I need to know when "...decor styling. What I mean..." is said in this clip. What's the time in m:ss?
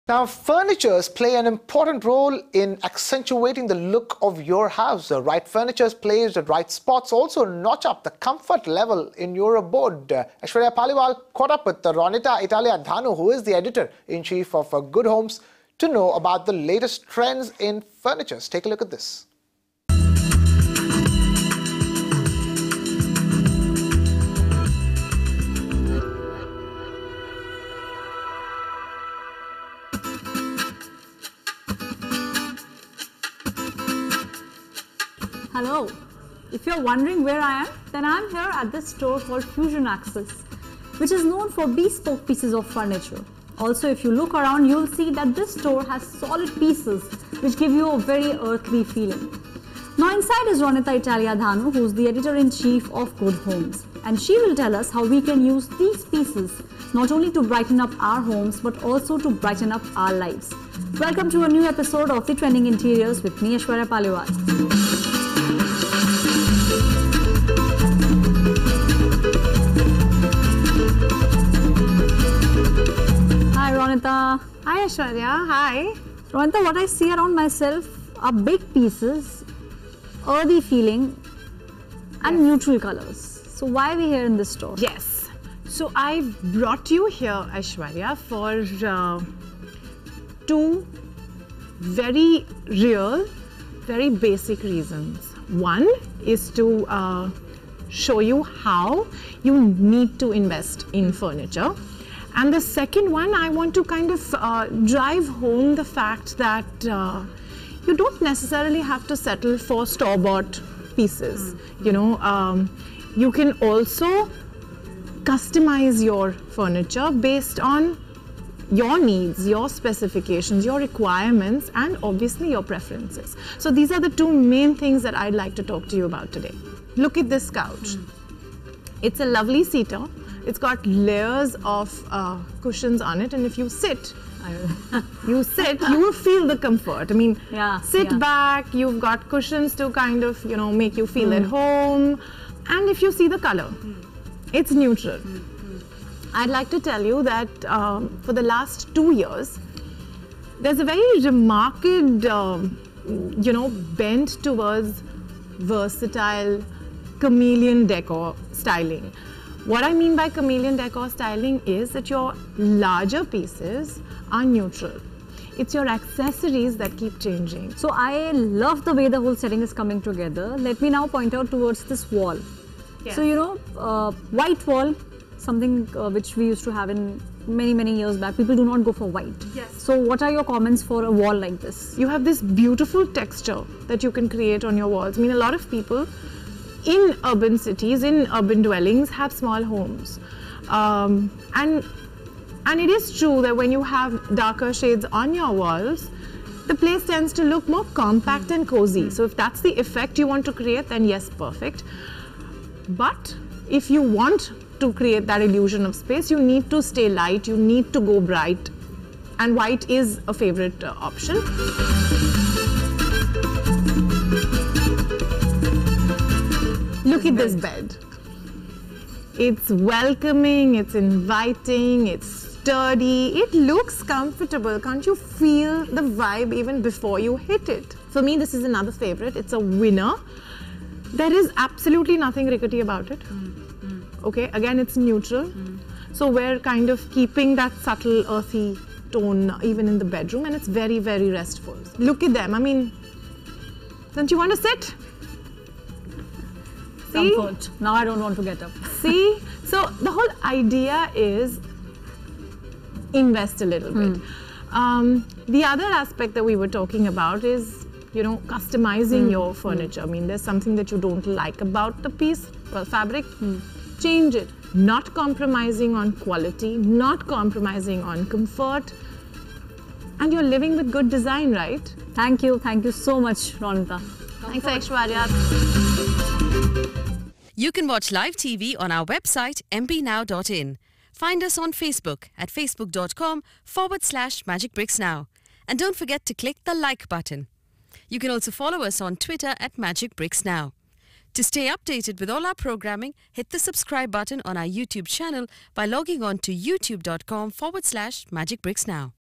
2:37.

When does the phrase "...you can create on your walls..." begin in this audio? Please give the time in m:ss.
3:04.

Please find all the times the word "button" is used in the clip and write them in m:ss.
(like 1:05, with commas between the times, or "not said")
4:47, 4:54.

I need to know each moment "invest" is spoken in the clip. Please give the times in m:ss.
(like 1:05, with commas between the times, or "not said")
1:40, 4:13.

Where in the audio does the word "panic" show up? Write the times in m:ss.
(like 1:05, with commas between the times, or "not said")
not said.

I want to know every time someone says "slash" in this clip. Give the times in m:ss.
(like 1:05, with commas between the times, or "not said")
4:44, 4:57.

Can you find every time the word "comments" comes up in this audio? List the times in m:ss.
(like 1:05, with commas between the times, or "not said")
3:00.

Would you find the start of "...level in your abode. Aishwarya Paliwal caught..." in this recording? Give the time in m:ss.
0:08.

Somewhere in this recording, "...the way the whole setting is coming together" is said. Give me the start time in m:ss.
2:48.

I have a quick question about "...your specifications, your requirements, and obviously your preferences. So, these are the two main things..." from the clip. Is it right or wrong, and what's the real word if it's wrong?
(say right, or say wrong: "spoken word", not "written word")
right.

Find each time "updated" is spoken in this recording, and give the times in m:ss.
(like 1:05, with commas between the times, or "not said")
4:51.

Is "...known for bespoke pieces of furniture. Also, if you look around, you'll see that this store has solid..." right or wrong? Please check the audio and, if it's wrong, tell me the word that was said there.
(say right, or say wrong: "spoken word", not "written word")
right.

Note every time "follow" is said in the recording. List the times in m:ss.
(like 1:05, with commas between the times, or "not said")
4:48.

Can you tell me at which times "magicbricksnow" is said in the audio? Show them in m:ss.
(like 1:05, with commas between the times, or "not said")
4:44, 4:49, 4:58.